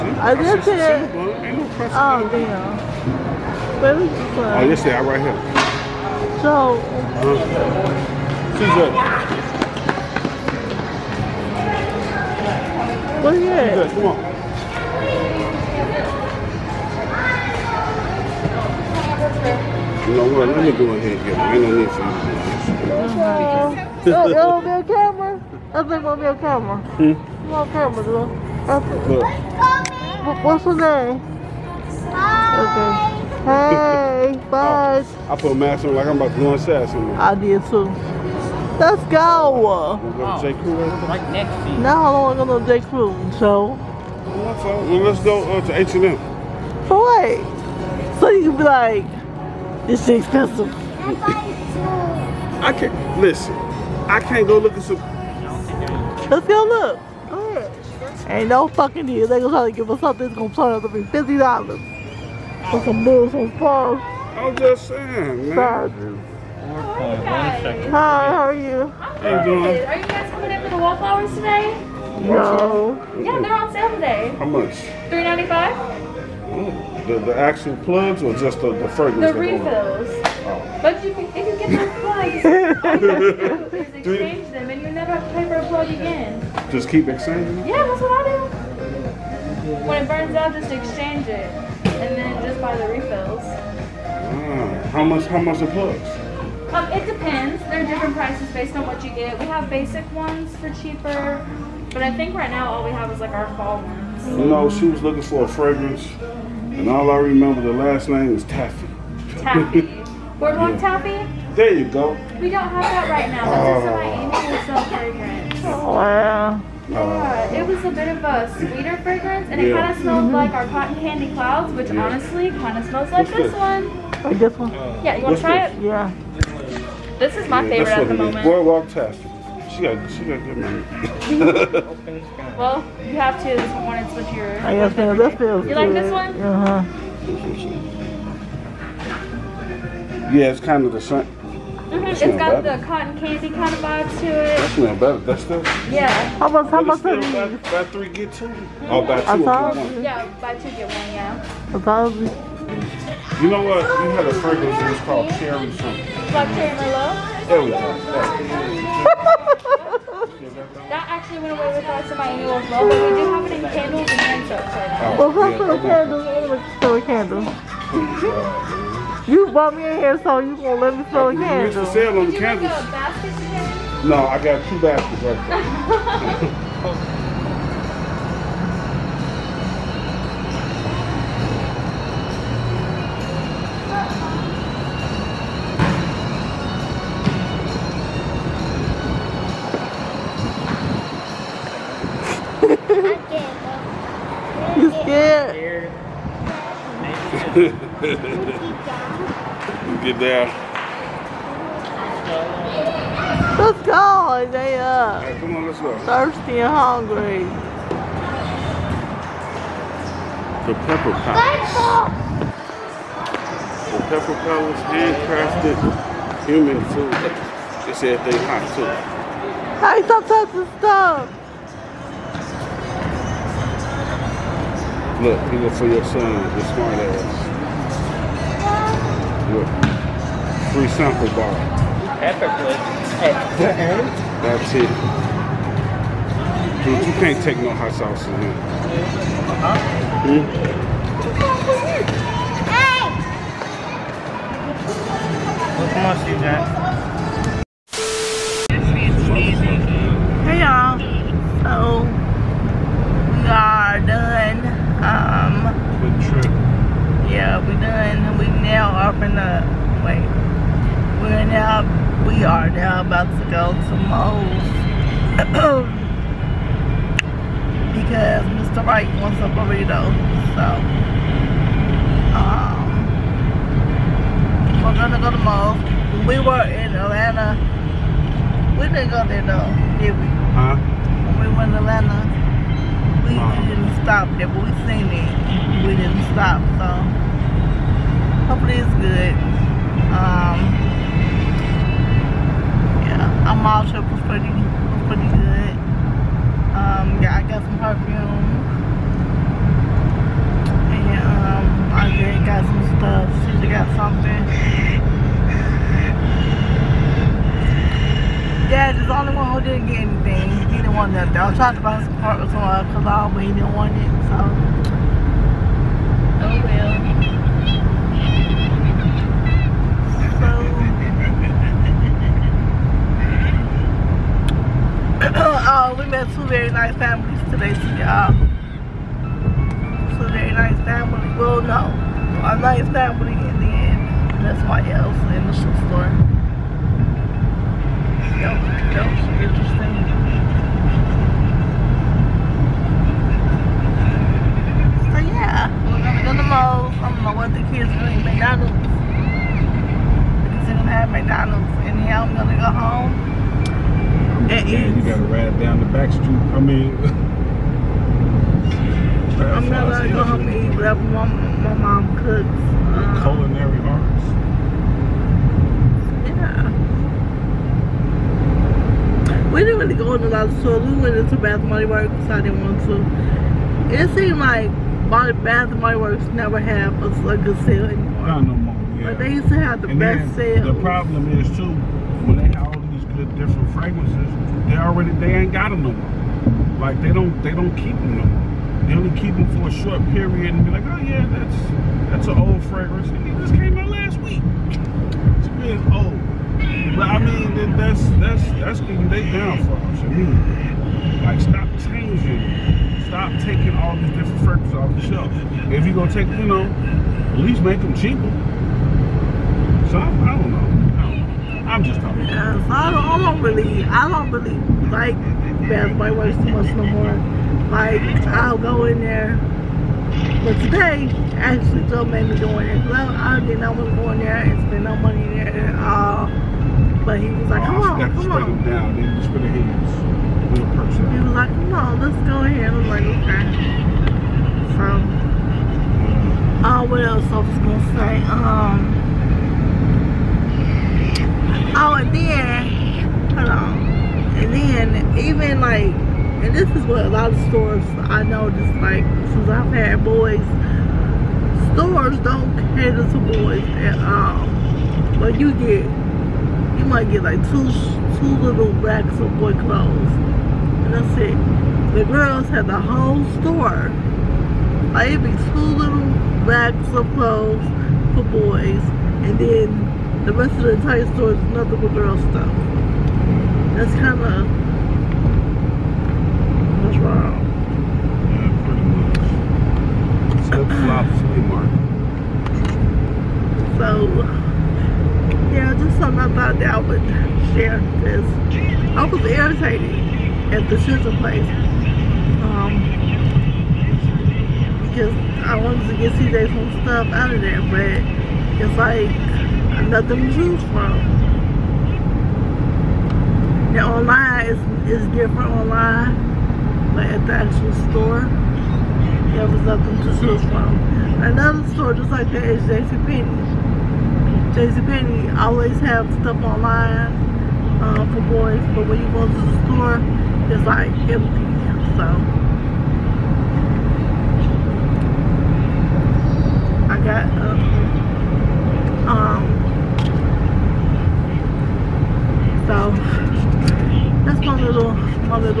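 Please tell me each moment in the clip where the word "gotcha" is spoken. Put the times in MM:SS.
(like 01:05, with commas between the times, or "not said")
not said.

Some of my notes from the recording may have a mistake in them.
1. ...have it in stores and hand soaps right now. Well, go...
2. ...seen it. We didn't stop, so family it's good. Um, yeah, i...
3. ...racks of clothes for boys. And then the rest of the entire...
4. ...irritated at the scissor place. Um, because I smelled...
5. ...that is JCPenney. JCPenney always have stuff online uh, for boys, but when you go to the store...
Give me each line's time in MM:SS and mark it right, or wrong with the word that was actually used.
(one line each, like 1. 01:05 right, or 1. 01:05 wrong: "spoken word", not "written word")
1. 02:43 wrong: "candles", not "stores"
2. 04:44 wrong: "hopefully", not "family"
3. 07:46 right
4. 08:09 wrong: "wanted", not "smelled"
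5. 08:32 right.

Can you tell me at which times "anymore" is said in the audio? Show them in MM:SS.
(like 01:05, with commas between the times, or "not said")
06:17.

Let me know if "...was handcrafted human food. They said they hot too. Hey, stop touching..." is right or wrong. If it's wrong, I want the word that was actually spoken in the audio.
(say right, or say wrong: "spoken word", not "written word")
right.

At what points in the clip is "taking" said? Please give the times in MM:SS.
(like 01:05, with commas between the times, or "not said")
06:43.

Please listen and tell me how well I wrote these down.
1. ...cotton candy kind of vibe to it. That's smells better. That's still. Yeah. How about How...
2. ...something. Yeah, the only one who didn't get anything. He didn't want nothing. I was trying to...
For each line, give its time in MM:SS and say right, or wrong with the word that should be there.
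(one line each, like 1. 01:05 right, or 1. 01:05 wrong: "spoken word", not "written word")
1. 02:22 right
2. 05:03 right.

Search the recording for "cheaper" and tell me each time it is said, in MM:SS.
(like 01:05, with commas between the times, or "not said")
01:40, 06:47.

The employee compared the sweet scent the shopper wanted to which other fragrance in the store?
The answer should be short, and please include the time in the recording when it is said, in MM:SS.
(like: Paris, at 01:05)
cotton candy clouds, at 02:00.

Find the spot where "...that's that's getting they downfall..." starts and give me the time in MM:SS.
06:38.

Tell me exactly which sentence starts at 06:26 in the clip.
Like they don't they don't keep them no more.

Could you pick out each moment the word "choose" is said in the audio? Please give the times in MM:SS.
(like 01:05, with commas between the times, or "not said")
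08:20, 08:30.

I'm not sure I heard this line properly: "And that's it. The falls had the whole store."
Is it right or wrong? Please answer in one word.
wrong.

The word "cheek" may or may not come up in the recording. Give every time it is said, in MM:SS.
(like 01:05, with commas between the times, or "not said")
not said.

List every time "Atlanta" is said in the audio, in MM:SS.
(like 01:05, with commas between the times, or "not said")
04:36, 04:41.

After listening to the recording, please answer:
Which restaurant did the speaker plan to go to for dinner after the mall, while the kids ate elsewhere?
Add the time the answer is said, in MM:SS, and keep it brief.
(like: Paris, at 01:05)
Moe's, at 05:46.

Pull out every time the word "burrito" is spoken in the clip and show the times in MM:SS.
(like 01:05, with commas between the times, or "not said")
04:29.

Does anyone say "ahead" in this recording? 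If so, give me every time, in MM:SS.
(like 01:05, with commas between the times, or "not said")
00:20, 07:12.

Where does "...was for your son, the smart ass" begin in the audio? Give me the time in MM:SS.
03:45.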